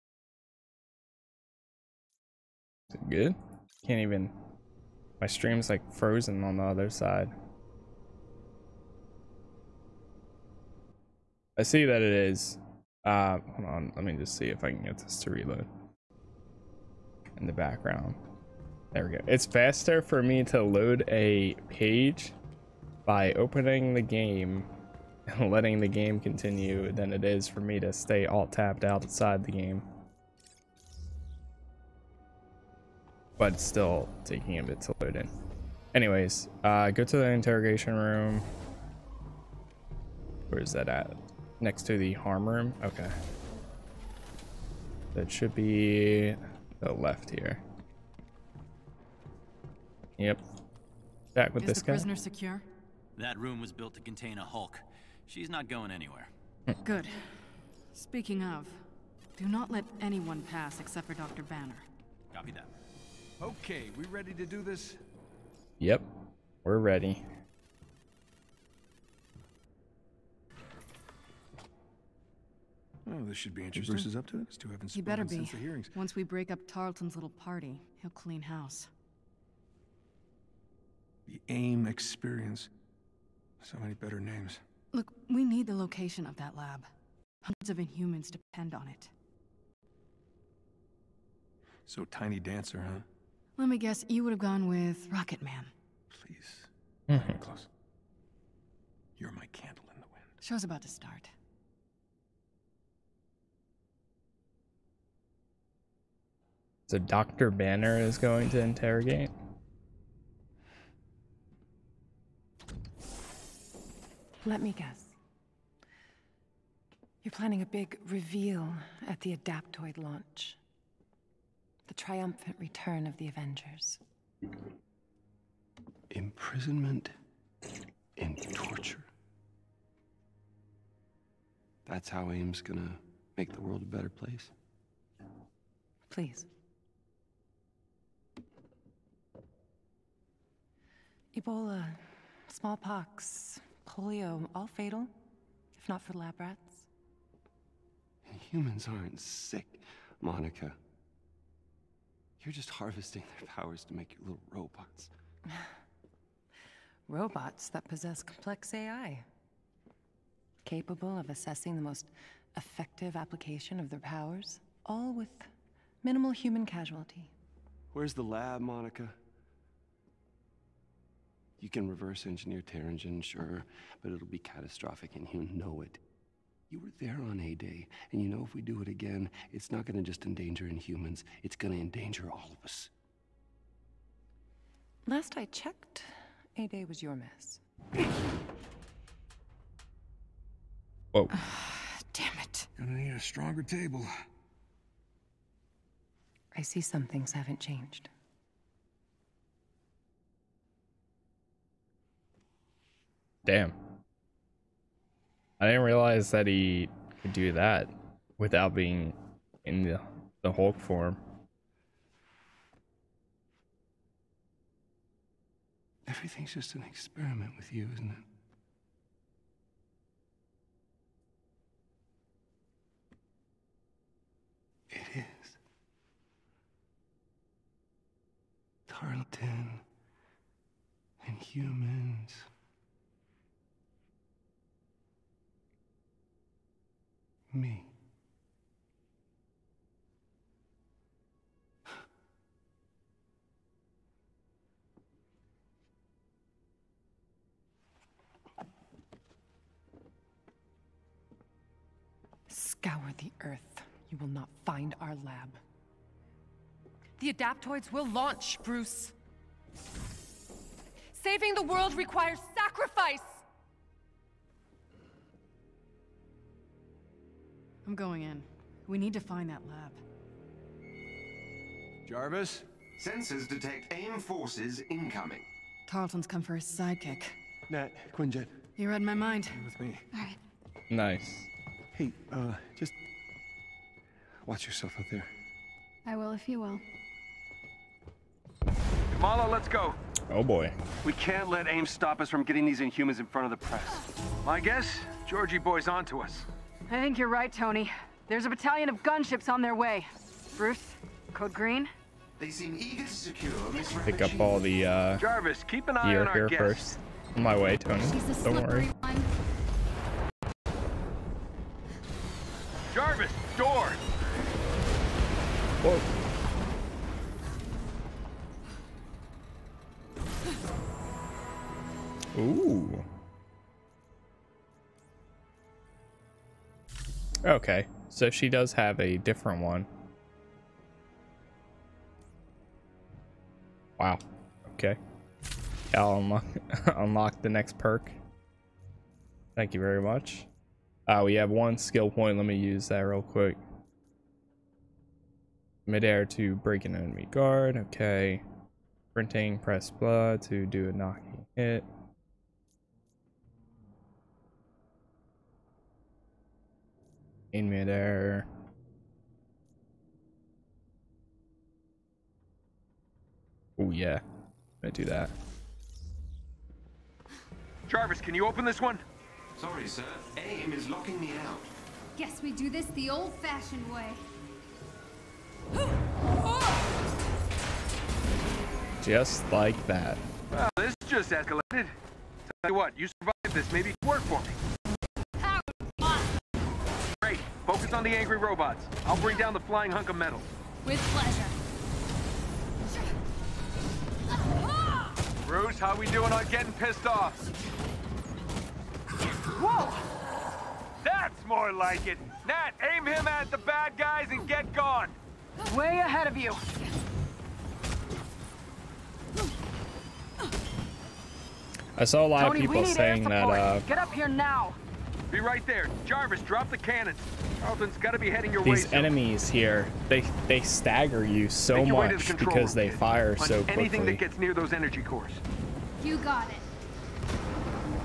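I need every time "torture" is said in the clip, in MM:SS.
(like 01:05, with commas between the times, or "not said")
02:08.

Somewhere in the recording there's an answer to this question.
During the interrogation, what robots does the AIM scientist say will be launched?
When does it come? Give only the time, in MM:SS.
01:59.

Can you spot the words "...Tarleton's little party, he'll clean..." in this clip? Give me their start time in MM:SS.
01:16.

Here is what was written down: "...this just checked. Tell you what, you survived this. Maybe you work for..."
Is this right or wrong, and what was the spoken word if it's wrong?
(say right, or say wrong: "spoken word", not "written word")
wrong: "escalated", not "checked".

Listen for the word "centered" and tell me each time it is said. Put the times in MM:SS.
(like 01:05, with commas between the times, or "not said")
not said.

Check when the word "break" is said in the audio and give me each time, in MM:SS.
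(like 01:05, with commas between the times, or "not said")
01:16, 05:46.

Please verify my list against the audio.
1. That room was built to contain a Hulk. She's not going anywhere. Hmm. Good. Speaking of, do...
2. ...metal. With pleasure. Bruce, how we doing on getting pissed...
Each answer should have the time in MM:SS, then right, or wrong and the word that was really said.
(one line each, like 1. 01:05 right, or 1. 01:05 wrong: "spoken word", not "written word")
1. 00:53 right
2. 06:30 right.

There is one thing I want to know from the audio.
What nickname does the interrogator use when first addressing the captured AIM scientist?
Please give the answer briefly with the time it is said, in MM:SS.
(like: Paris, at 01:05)
Tiny Dancer, at 01:32.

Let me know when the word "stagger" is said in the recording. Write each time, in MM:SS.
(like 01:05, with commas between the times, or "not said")
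07:00.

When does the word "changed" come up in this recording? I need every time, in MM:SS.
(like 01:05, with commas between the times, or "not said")
03:17.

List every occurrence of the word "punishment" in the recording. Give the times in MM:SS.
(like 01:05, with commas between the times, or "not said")
not said.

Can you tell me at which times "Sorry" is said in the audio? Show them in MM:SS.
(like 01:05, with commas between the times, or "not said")
06:09.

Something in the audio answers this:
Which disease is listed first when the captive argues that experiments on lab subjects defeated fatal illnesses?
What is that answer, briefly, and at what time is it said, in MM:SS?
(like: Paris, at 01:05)
Ebola, at 02:21.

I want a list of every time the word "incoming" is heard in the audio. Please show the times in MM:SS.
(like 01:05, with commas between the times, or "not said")
04:34.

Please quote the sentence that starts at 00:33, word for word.
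but still taking a bit to load in.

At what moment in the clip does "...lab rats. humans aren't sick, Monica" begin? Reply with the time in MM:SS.
02:26.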